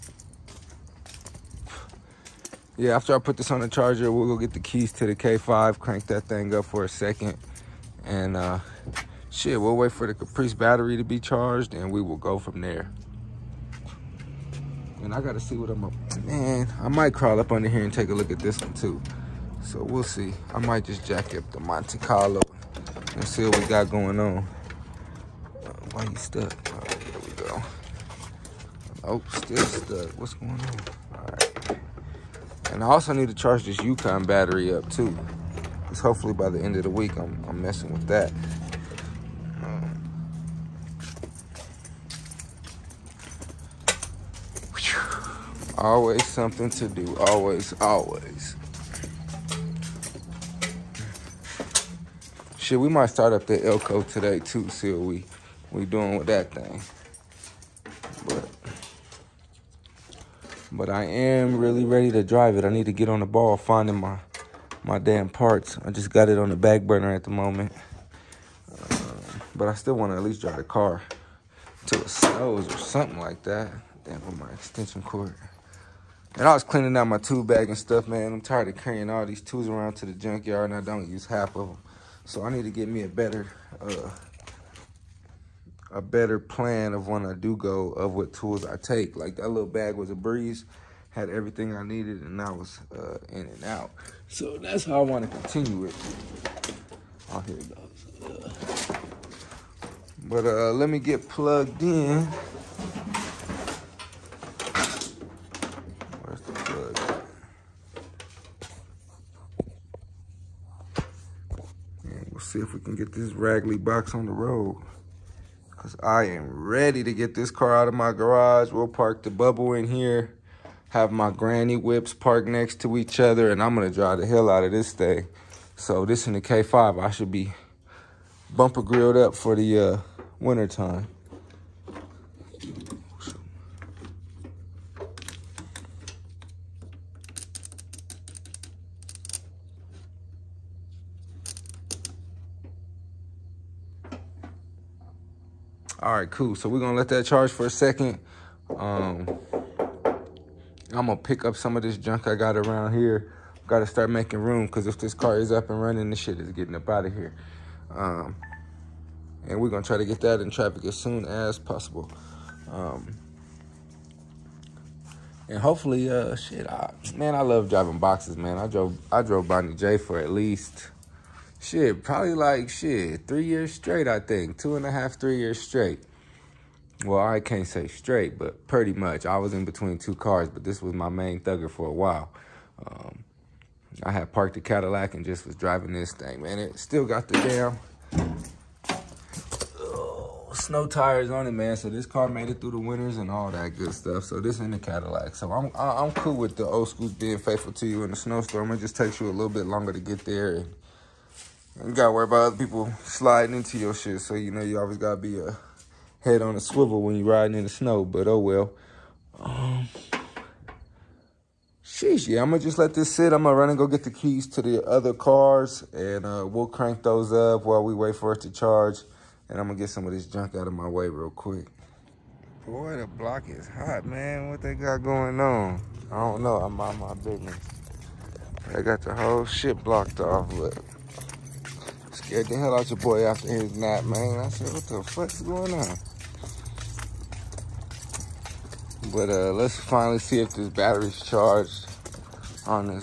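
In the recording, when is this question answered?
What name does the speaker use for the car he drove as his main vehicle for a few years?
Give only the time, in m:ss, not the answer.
2:49.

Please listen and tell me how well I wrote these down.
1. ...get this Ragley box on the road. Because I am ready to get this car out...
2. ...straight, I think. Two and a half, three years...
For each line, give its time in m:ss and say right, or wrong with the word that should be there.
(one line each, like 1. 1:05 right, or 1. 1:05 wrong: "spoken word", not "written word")
1. 1:52 right
2. 2:53 right.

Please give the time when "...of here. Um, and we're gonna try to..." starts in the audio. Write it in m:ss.
2:37.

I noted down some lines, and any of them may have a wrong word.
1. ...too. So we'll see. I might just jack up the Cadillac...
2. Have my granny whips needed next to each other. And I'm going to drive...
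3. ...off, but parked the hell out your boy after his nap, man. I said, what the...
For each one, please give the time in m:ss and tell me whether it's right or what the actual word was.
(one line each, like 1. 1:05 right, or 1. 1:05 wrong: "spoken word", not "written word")
1. 0:18 wrong: "Monte", not "Cadillac"
2. 2:00 wrong: "parked", not "needed"
3. 3:50 wrong: "scared", not "parked".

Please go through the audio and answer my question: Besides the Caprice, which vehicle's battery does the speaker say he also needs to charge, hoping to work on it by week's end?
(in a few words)
Yukon.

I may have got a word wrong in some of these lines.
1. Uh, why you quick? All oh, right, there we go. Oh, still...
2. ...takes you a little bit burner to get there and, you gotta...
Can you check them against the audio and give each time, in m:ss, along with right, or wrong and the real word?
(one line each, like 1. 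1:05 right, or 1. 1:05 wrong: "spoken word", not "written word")
1. 0:25 wrong: "stuck", not "quick"
2. 3:18 wrong: "longer", not "burner".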